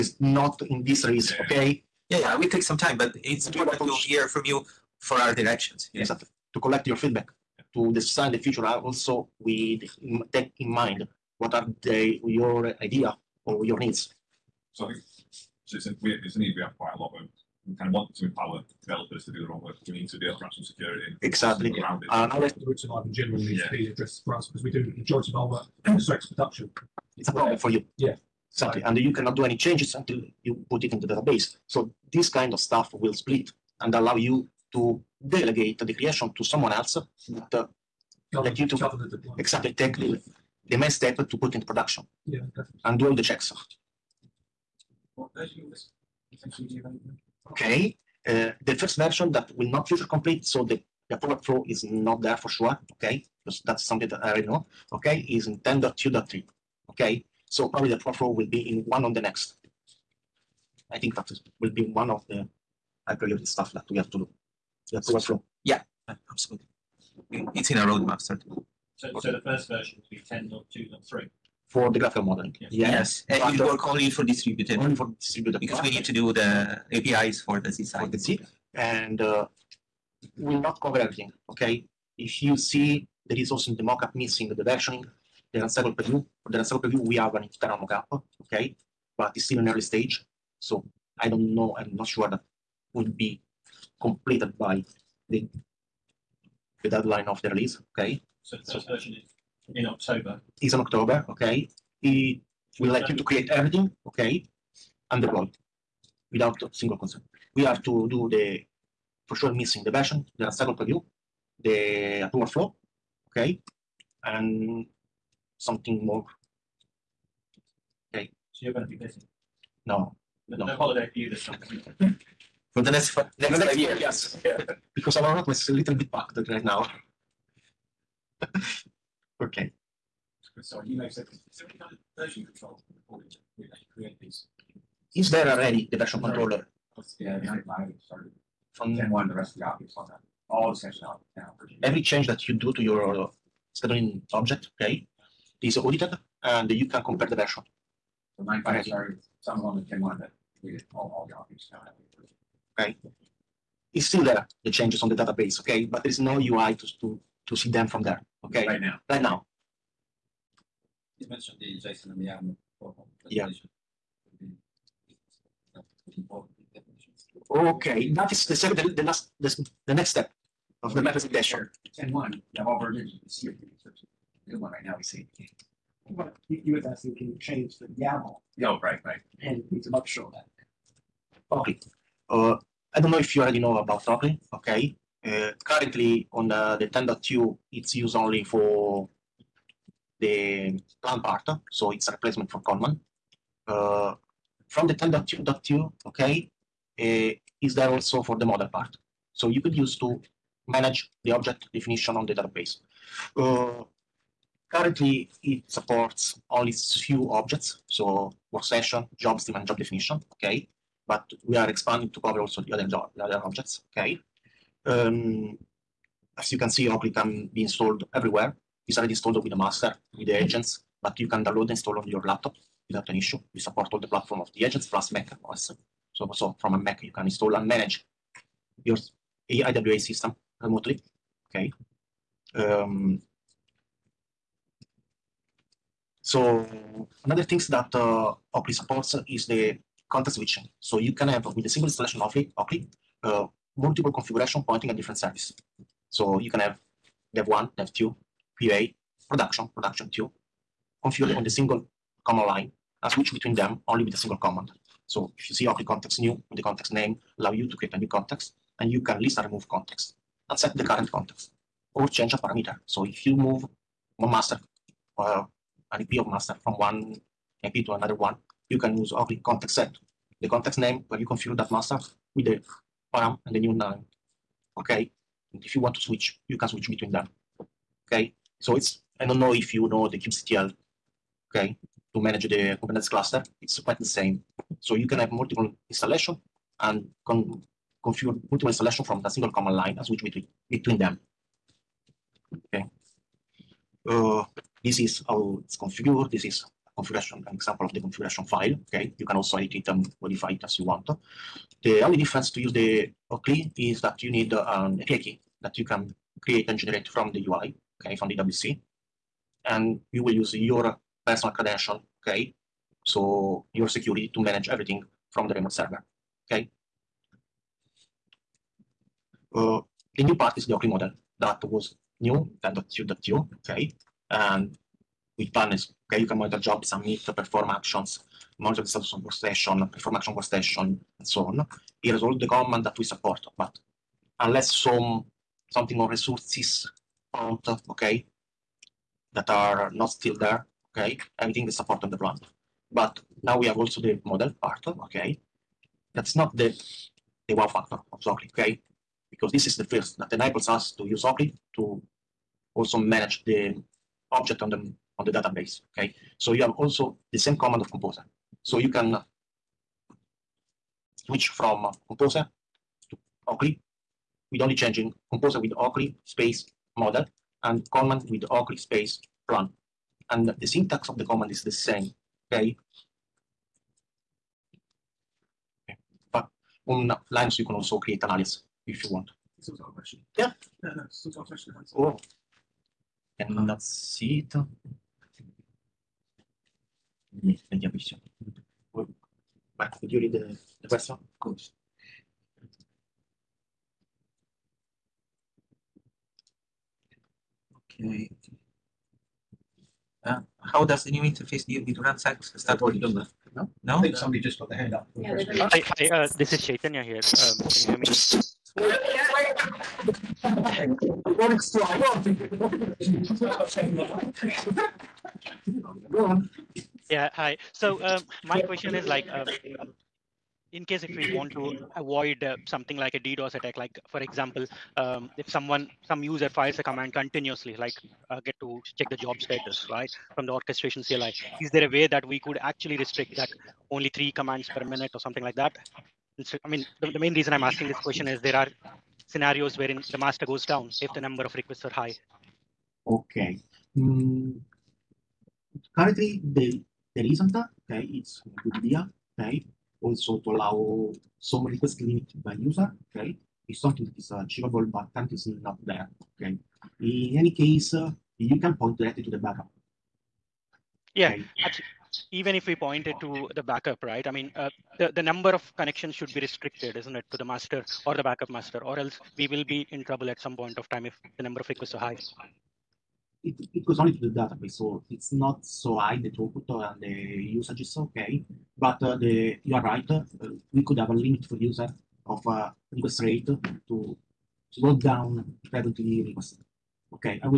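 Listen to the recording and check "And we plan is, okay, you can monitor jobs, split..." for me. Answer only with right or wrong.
wrong.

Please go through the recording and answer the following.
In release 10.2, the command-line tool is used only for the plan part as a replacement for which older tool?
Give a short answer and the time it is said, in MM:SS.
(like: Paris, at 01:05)
Conman, at 03:11.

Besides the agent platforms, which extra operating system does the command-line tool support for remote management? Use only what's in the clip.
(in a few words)
Mac OS.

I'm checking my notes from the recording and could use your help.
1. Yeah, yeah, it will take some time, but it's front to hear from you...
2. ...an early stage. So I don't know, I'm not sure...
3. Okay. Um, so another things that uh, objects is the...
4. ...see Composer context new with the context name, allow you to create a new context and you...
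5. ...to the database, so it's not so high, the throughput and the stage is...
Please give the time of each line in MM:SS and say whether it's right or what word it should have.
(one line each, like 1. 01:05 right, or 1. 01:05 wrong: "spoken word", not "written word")
1. 00:02 wrong: "important", not "front"
2. 01:29 right
3. 03:51 wrong: "supports", not "objects"
4. 04:15 wrong: "OCLI", not "Composer"
5. 07:54 wrong: "usage", not "stage".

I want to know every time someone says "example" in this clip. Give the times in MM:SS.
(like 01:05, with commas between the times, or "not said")
04:57, 07:04.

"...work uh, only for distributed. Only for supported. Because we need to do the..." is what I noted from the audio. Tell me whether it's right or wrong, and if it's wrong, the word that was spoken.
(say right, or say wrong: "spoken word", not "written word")
wrong: "distributed", not "supported".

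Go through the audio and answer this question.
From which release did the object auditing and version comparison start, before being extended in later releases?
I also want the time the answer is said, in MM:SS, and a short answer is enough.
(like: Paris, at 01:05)
9.5, at 02:28.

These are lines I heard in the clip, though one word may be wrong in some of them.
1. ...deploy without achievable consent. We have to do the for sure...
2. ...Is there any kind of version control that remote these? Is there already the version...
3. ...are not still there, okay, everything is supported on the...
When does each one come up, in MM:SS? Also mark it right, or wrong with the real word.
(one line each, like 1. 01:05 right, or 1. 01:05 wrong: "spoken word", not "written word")
1. 01:45 wrong: "single", not "achievable"
2. 02:11 wrong: "create", not "remote"
3. 05:39 right.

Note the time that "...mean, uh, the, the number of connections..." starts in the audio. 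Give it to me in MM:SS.
07:44.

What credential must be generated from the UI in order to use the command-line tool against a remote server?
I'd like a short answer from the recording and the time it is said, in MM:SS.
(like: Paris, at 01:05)
API key, at 05:04.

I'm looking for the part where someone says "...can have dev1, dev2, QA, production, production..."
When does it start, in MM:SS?
04:06.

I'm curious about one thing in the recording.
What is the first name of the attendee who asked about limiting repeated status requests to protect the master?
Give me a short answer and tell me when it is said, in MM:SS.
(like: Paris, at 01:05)
Chaitanya, at 06:46.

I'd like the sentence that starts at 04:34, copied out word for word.
Okay, and if you want to switch, you can switch between them.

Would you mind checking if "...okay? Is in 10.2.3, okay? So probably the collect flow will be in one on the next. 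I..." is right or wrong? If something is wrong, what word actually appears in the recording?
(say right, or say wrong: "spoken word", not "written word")
wrong: "product", not "collect".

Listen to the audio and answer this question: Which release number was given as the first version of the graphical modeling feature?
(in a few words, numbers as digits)
10.2.3.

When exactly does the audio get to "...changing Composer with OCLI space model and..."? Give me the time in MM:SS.
06:04.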